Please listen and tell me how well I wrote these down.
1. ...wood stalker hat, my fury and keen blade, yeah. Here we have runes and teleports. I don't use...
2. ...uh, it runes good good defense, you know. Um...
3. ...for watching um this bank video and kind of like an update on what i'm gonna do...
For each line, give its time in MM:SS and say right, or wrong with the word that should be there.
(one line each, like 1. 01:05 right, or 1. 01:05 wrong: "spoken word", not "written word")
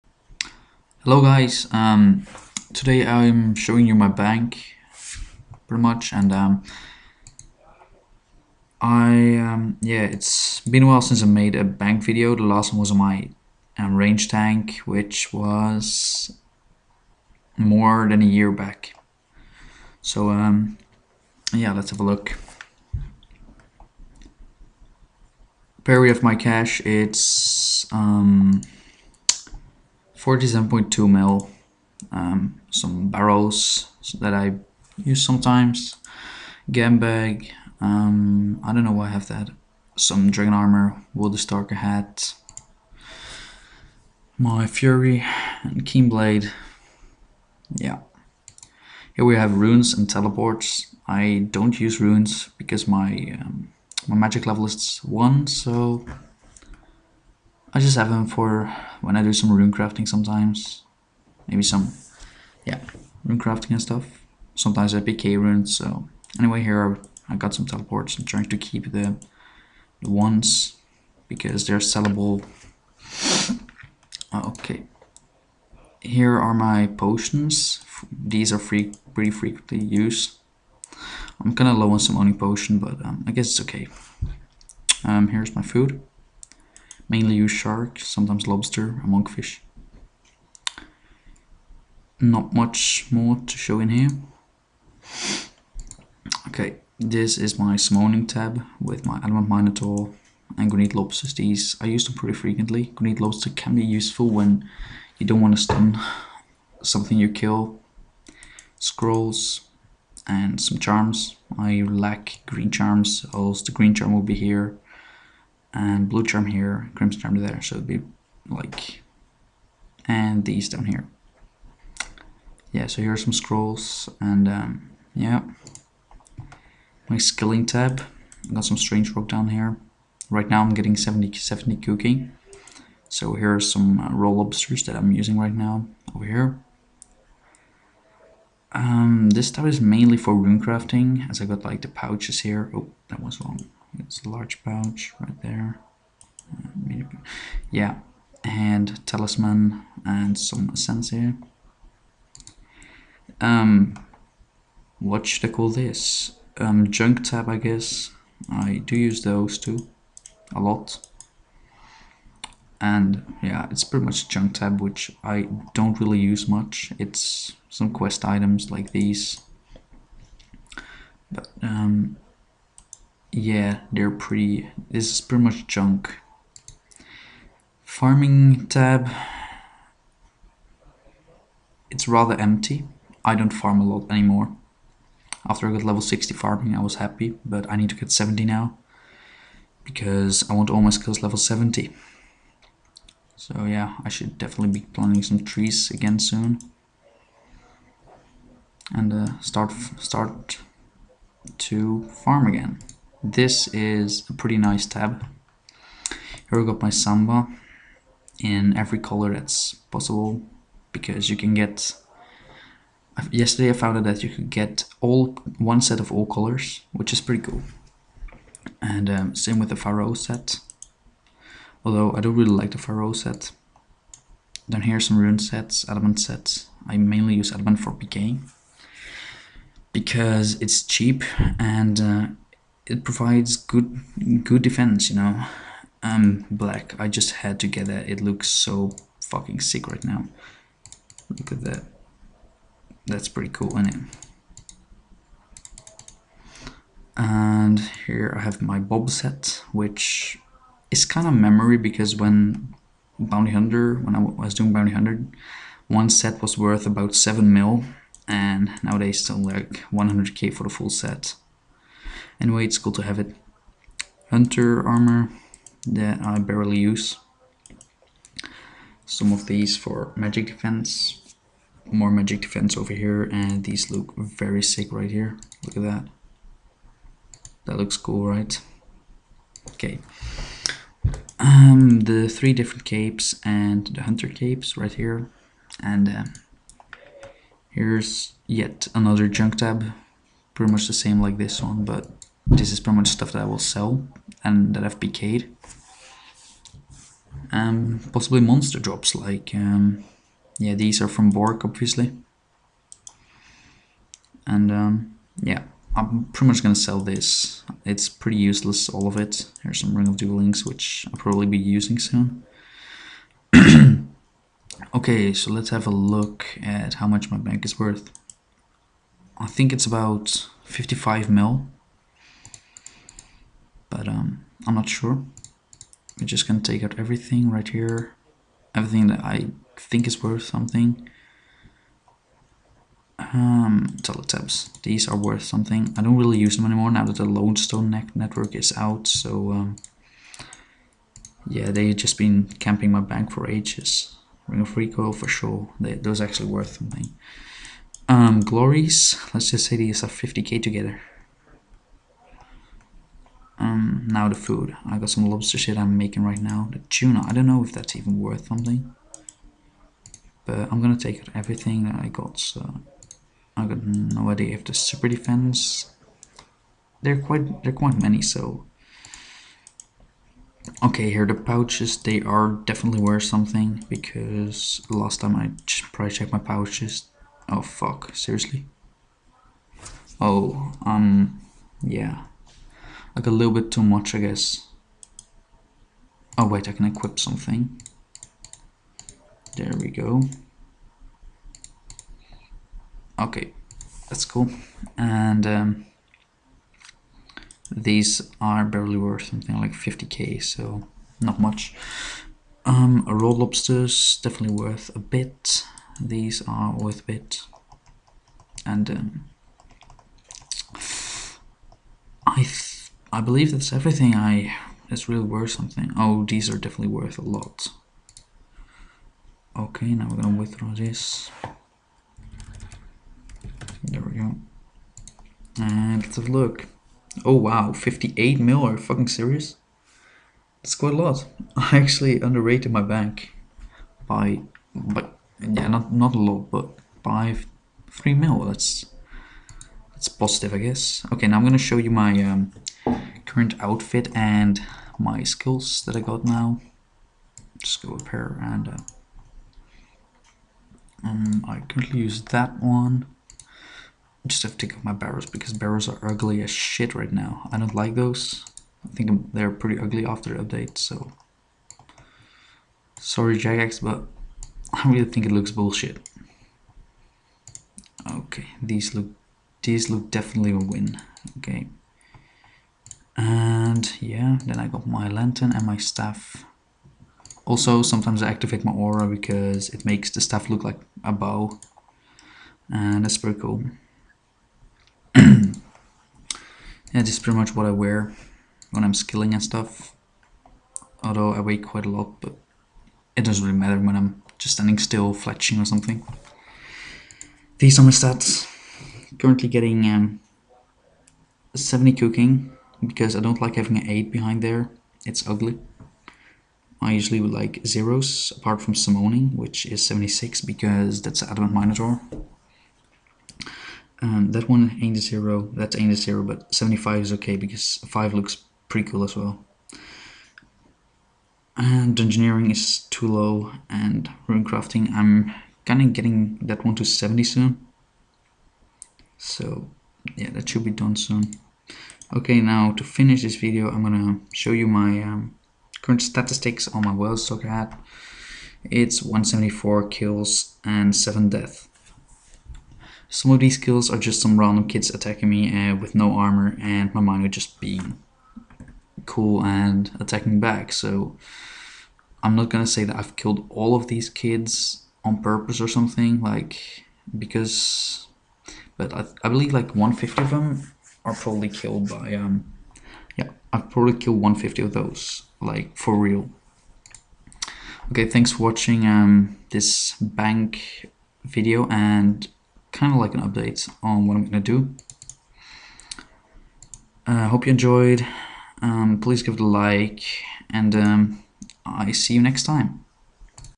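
1. 00:41 right
2. 03:52 wrong: "provides", not "runes"
3. 09:28 right.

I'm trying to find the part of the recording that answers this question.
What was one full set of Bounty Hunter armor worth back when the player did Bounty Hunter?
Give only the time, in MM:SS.
04:17.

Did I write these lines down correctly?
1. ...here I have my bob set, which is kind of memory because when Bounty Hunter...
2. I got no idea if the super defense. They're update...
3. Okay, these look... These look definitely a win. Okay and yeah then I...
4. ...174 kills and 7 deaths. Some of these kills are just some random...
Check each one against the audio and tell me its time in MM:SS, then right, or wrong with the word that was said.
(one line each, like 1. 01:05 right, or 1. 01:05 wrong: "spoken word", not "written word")
1. 04:08 right
2. 06:03 wrong: "quite", not "update"
3. 07:48 right
4. 08:59 right.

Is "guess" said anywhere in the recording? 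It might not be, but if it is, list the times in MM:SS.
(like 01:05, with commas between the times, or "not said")
01:23, 02:37, 06:24, 07:20.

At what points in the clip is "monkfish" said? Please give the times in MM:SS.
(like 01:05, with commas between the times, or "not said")
01:29.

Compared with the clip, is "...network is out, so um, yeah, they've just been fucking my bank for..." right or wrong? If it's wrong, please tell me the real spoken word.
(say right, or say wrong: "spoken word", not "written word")
wrong: "camping", not "fucking".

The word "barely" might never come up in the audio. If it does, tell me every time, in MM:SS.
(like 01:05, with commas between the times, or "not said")
04:26, 06:38.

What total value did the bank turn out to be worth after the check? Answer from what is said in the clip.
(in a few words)
58 mil.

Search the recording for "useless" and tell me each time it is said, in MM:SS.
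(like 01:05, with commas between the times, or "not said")
05:08.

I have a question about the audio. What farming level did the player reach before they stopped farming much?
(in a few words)
60.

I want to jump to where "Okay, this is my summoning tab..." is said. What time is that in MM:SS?
01:36.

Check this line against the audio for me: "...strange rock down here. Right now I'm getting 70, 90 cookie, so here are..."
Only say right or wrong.
wrong.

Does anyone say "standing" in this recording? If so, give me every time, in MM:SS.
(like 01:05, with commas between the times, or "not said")
08:14.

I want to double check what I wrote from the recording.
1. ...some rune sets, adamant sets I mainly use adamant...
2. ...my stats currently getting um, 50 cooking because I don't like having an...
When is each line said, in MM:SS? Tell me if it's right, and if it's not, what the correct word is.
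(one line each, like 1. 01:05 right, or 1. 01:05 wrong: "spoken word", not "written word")
1. 03:44 right
2. 08:17 wrong: "70", not "50".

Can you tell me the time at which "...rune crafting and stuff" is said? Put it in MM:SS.
01:03.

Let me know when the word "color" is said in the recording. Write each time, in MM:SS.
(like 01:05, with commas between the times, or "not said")
03:28, 03:36.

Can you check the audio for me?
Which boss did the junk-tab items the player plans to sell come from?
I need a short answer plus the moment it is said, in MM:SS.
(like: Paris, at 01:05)
Bork, at 05:01.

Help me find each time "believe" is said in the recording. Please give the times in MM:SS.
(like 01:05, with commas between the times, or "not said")
06:53, 09:19.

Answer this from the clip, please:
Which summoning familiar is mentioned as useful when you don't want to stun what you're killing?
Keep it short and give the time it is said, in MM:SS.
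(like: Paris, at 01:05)
Granite lobster, at 01:42.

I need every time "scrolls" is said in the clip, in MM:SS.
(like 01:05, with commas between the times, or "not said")
01:48, 02:03.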